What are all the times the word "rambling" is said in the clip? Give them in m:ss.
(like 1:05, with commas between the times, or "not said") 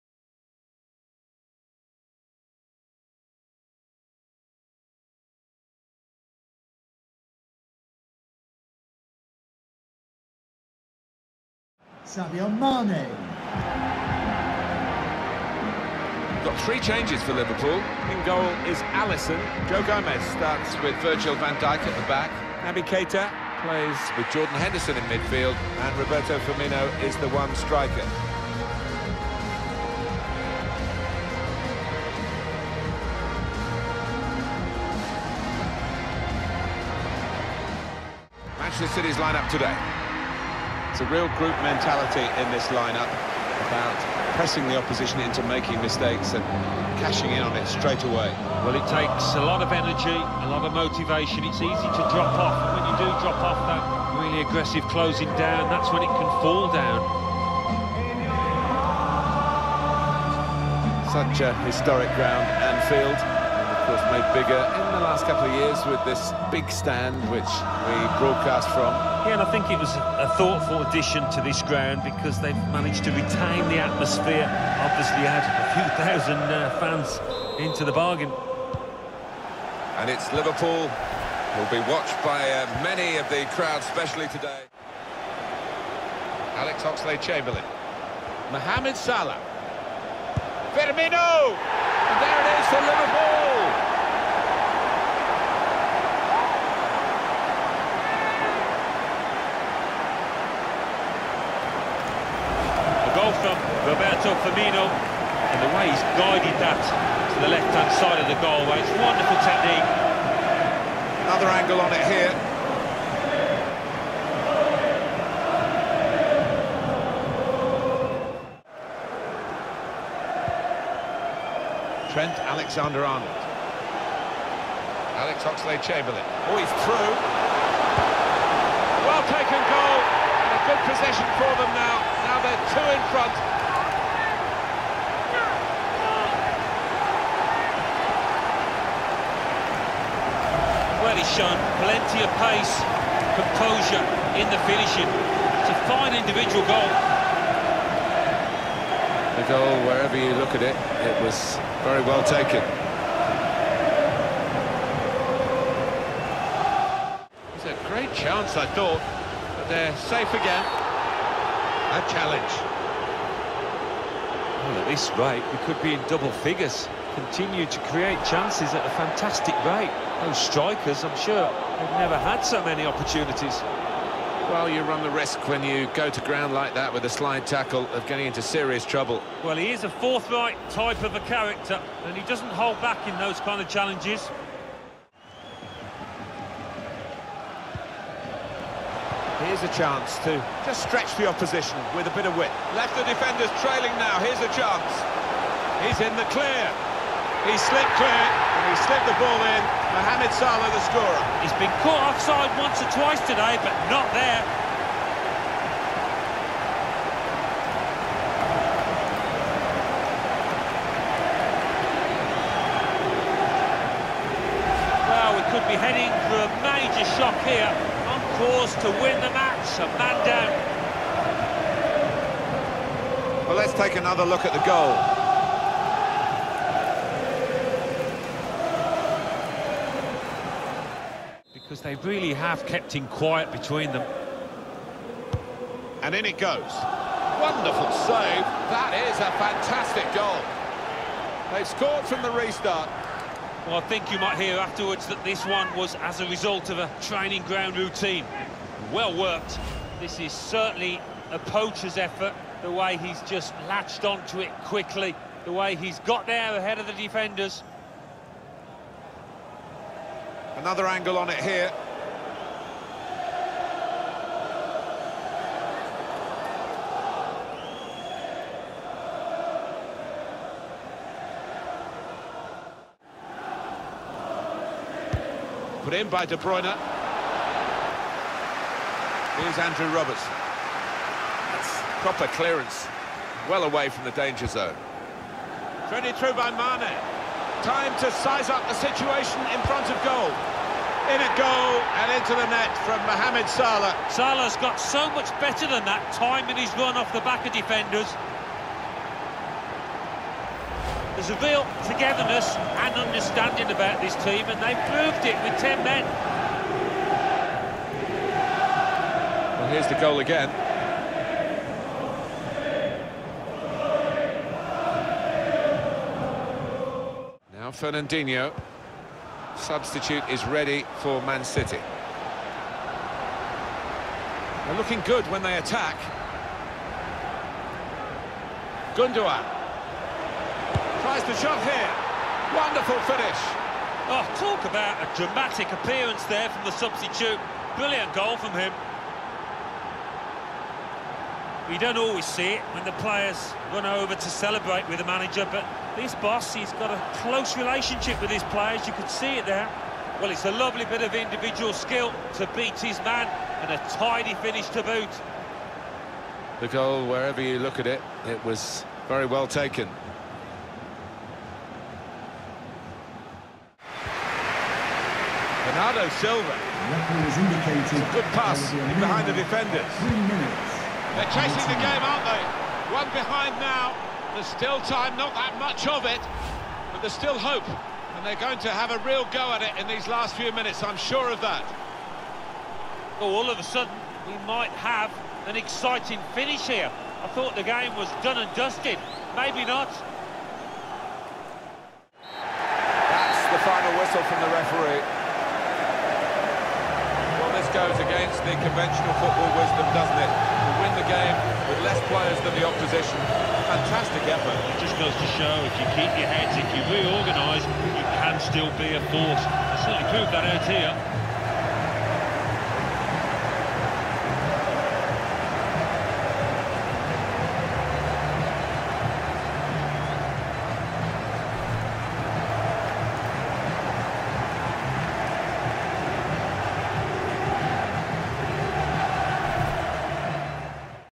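not said.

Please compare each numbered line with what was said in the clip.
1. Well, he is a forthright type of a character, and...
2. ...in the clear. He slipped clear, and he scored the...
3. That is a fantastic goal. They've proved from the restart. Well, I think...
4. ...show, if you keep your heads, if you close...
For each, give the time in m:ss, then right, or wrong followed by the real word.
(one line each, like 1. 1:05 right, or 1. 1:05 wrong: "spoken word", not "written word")
1. 2:59 right
2. 3:16 wrong: "slipped", not "scored"
3. 3:58 wrong: "scored", not "proved"
4. 6:45 wrong: "reorganise", not "close".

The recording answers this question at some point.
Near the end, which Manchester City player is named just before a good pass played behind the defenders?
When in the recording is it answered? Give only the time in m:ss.
6:05.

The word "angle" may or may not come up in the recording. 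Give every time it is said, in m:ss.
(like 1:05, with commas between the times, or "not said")
1:51, 4:20.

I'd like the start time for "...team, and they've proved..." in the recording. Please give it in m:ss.
5:04.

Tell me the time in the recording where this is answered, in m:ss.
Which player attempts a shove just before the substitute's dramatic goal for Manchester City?
5:28.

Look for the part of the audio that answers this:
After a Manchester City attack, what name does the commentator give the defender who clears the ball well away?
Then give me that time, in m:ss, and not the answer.
4:39.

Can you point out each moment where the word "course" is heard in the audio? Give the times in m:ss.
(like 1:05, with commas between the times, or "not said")
1:03, 3:38.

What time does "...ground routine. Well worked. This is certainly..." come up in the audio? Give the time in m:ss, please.
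4:07.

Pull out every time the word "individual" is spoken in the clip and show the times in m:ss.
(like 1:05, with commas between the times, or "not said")
2:26, 5:51.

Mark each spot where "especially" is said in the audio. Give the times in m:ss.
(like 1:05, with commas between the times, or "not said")
1:23.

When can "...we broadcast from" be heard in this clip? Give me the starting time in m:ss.
1:07.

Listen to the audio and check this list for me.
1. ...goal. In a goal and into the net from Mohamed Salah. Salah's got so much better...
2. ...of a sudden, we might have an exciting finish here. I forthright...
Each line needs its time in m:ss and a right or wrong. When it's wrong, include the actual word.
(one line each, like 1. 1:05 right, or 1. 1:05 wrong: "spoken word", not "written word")
1. 4:50 right
2. 6:23 wrong: "thought", not "forthright".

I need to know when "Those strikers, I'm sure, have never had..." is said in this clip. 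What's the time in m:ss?
2:50.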